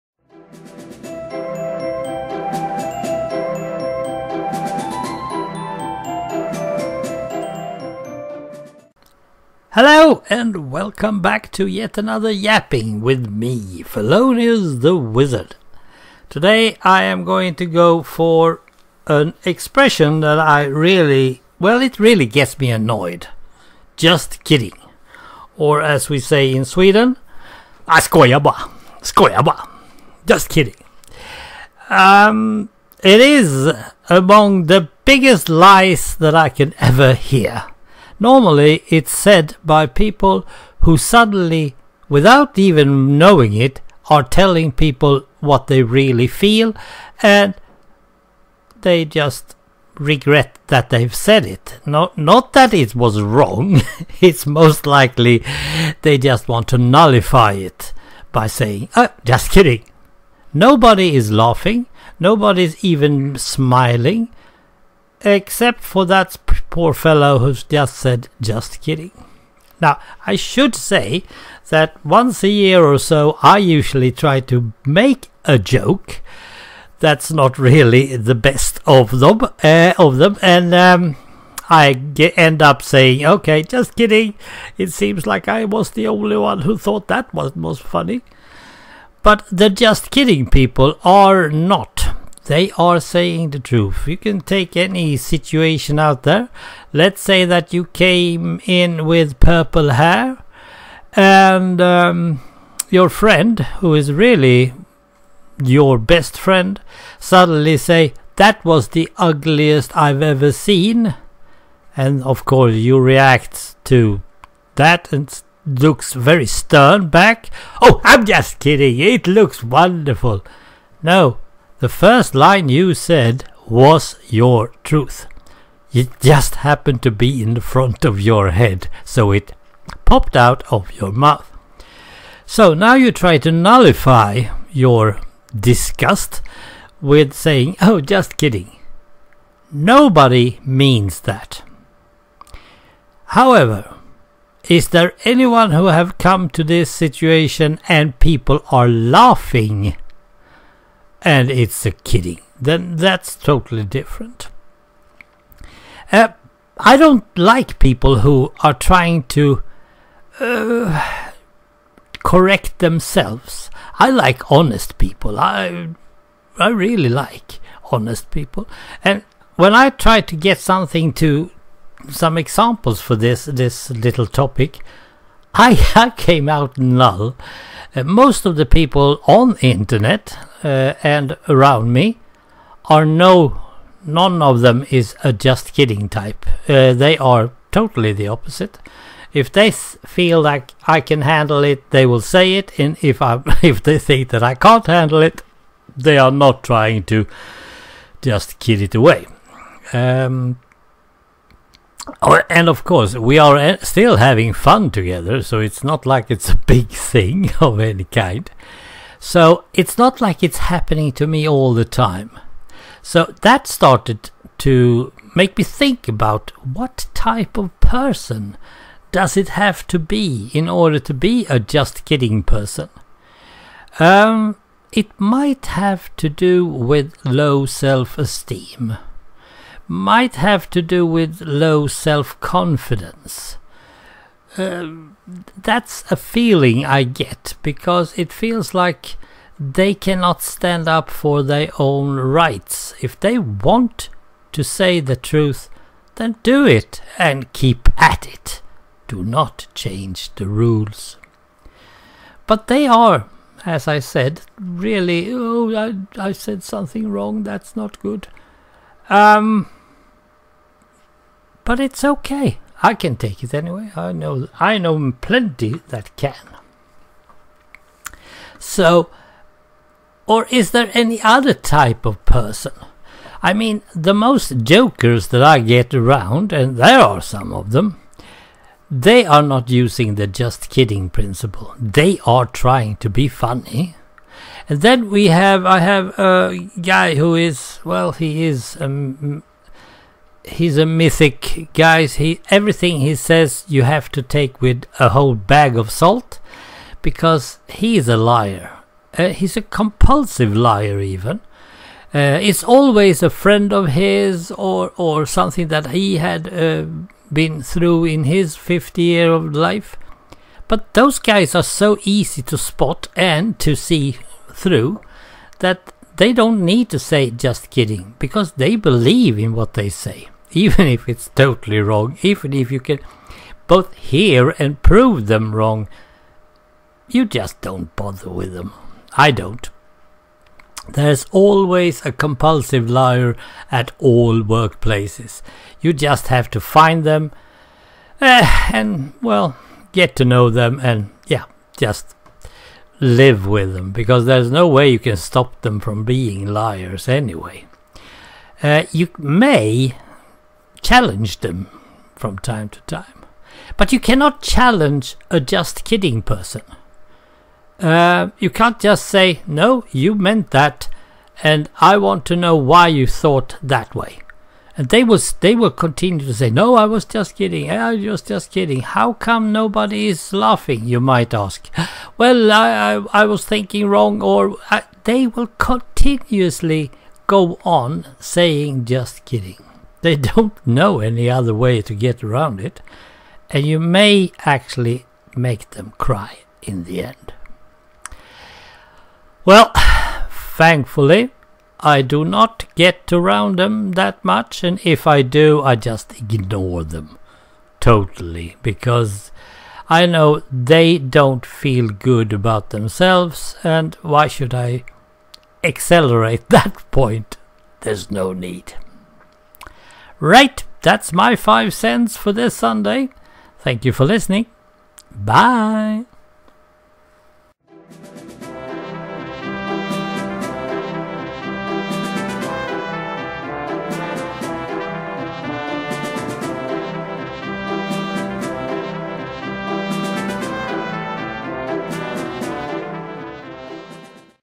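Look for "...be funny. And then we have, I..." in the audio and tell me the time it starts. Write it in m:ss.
4:43.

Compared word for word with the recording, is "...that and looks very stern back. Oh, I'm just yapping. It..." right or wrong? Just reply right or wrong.
wrong.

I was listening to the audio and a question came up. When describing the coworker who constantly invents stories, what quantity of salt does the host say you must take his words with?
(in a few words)
a whole bag.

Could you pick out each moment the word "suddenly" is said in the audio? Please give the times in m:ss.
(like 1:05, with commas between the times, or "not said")
0:40, 1:47.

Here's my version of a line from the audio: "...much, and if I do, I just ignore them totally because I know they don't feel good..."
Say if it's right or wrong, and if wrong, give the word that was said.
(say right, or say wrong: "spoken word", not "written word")
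right.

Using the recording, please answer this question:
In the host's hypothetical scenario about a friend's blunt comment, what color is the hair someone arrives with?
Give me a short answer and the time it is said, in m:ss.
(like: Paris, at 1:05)
purple, at 1:39.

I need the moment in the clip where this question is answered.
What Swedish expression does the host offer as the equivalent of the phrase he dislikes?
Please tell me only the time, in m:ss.
0:27.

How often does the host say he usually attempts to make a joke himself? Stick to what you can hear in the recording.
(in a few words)
once a year.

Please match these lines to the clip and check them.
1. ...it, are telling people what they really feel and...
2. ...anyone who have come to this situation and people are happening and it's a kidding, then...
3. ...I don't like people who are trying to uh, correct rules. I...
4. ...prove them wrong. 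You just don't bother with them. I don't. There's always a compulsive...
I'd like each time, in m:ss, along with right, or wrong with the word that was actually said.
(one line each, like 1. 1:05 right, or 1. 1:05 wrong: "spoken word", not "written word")
1. 0:43 right
2. 2:25 wrong: "laughing", not "happening"
3. 2:36 wrong: "themselves", not "rules"
4. 5:24 right.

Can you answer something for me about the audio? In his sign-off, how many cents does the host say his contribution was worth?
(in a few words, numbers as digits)
5.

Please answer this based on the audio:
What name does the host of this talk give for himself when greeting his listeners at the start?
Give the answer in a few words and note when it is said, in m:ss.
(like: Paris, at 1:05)
Fellonius the Wizard, at 0:13.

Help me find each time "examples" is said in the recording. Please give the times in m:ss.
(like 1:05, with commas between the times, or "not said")
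2:52.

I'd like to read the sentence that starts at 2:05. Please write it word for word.
It just happened to be in the front of your head, so it popped out of your mouth.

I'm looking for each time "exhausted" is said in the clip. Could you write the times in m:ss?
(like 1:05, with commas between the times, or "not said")
not said.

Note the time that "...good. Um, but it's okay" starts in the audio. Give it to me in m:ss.
4:17.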